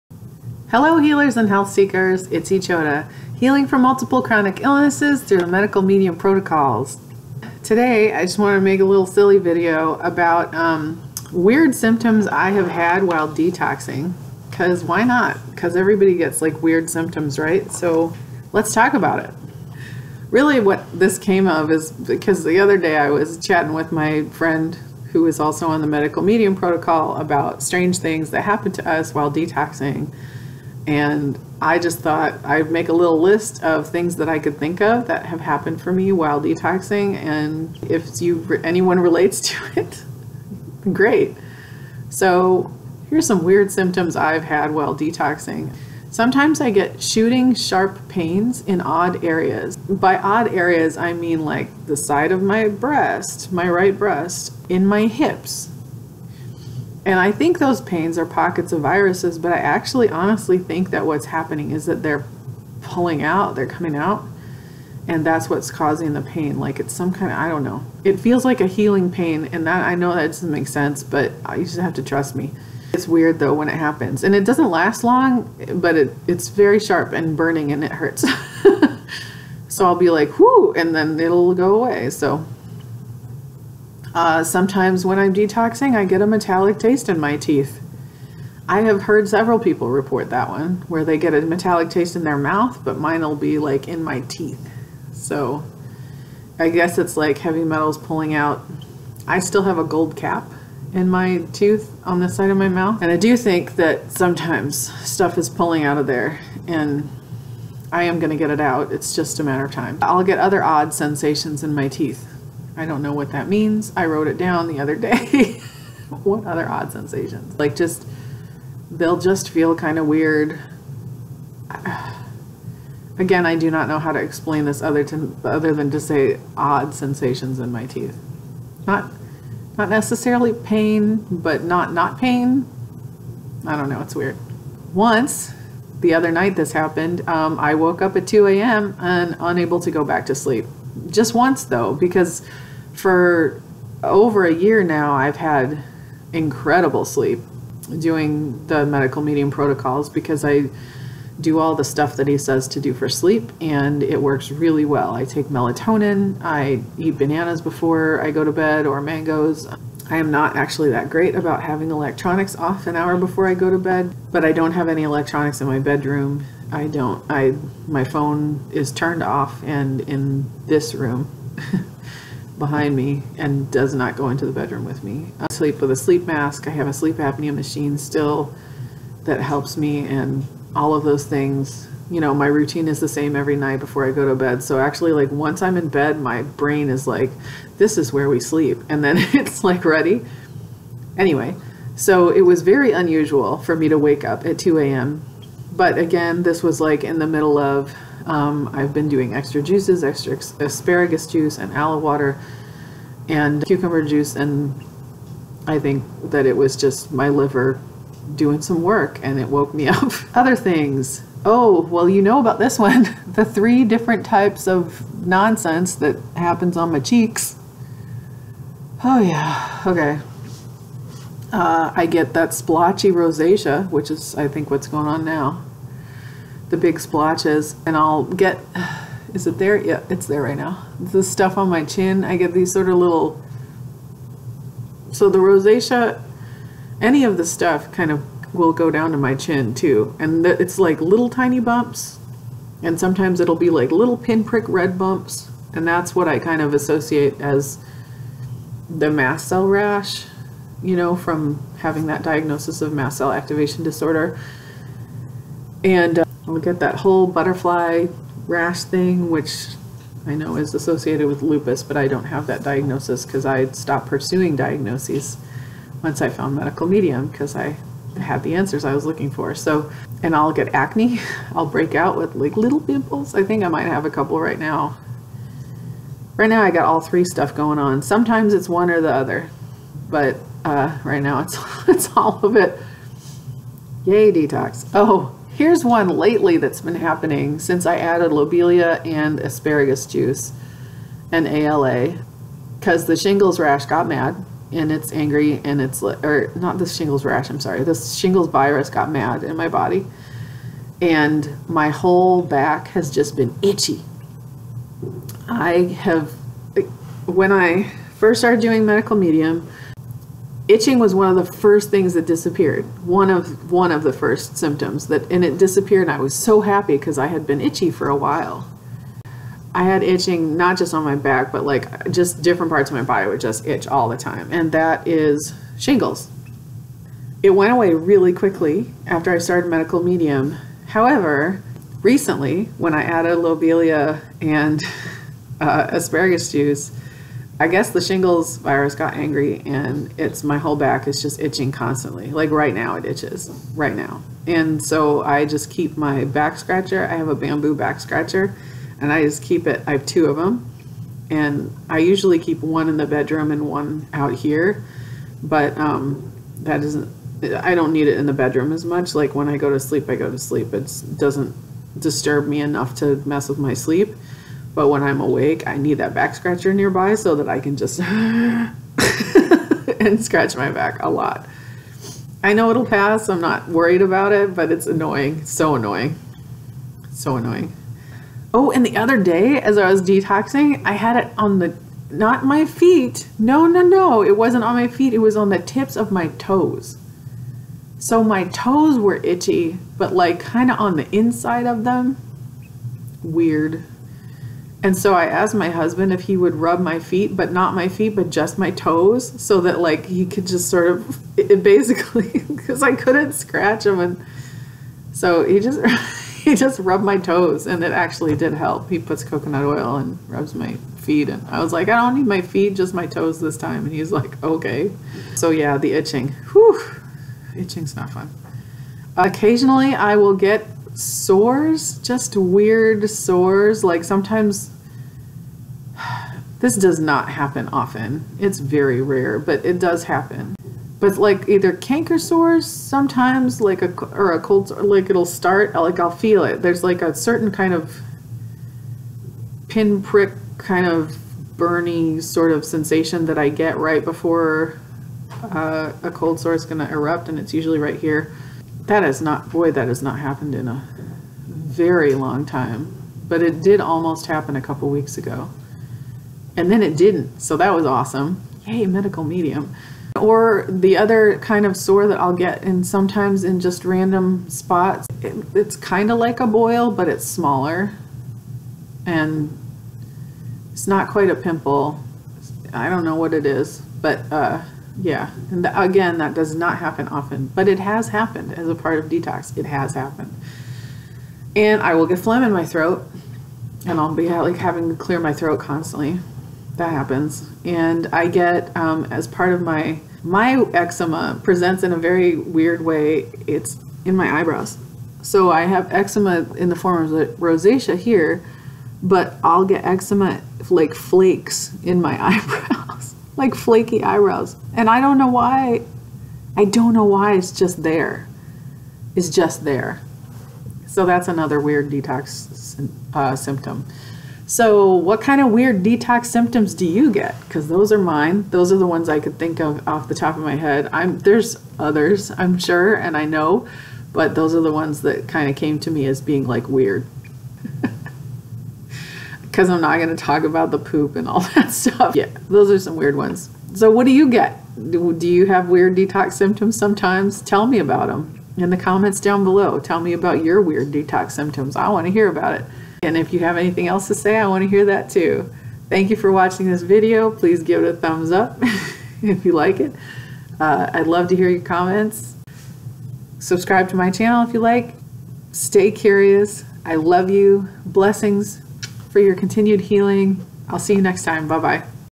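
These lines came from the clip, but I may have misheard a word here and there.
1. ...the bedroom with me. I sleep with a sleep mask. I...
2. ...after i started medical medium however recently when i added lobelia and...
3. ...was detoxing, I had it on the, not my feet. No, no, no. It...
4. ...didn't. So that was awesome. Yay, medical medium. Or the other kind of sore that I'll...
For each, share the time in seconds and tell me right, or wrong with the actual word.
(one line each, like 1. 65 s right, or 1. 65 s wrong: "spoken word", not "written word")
1. 174 s right
2. 329 s right
3. 379 s right
4. 456 s right.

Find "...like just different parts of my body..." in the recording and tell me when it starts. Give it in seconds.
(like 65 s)
321 s.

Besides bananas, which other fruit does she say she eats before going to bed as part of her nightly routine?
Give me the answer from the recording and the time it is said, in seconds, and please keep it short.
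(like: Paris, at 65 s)
Mangoes, at 159 s.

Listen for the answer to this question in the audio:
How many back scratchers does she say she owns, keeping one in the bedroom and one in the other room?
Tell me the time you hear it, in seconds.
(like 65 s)
350 s.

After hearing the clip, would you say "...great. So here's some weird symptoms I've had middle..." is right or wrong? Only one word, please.
wrong.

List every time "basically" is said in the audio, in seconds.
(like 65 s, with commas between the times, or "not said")
401 s.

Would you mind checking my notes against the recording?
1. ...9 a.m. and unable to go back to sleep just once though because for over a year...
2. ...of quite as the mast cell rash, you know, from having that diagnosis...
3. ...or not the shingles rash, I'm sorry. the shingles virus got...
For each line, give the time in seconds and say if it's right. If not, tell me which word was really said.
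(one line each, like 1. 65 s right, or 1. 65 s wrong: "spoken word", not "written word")
1. 138 s wrong: "2", not "9"
2. 246 s wrong: "associate", not "quite"
3. 296 s right.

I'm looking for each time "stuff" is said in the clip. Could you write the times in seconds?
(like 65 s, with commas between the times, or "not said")
105 s, 151 s, 231 s, 237 s, 277 s, 531 s.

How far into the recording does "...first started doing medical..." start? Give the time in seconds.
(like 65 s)
308 s.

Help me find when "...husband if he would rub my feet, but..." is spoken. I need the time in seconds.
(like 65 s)
395 s.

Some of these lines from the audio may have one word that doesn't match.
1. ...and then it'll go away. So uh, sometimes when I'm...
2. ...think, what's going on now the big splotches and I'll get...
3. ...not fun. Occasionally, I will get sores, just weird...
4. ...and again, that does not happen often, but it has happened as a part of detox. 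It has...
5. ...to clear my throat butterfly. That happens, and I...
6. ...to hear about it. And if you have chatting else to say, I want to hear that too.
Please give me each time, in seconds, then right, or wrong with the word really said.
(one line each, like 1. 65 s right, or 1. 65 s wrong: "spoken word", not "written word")
1. 80 s right
2. 224 s right
3. 417 s right
4. 475 s right
5. 484 s wrong: "constantly", not "butterfly"
6. 542 s wrong: "anything", not "chatting".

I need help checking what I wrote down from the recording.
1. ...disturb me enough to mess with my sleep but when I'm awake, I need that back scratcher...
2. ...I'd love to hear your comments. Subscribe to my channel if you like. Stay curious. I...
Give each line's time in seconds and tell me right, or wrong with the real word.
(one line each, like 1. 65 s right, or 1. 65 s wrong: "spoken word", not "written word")
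1. 361 s right
2. 550 s right.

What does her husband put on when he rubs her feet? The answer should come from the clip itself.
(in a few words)
Coconut oil.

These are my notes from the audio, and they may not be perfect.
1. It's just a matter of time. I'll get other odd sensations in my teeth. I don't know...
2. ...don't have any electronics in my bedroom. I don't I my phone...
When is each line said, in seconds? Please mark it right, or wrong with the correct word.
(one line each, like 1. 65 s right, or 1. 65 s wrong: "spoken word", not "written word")
1. 108 s right
2. 164 s right.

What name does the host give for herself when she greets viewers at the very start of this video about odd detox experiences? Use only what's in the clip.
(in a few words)
Echota.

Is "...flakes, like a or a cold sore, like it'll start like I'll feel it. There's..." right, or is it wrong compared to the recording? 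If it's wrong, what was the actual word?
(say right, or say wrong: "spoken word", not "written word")
wrong: "sometimes", not "flakes".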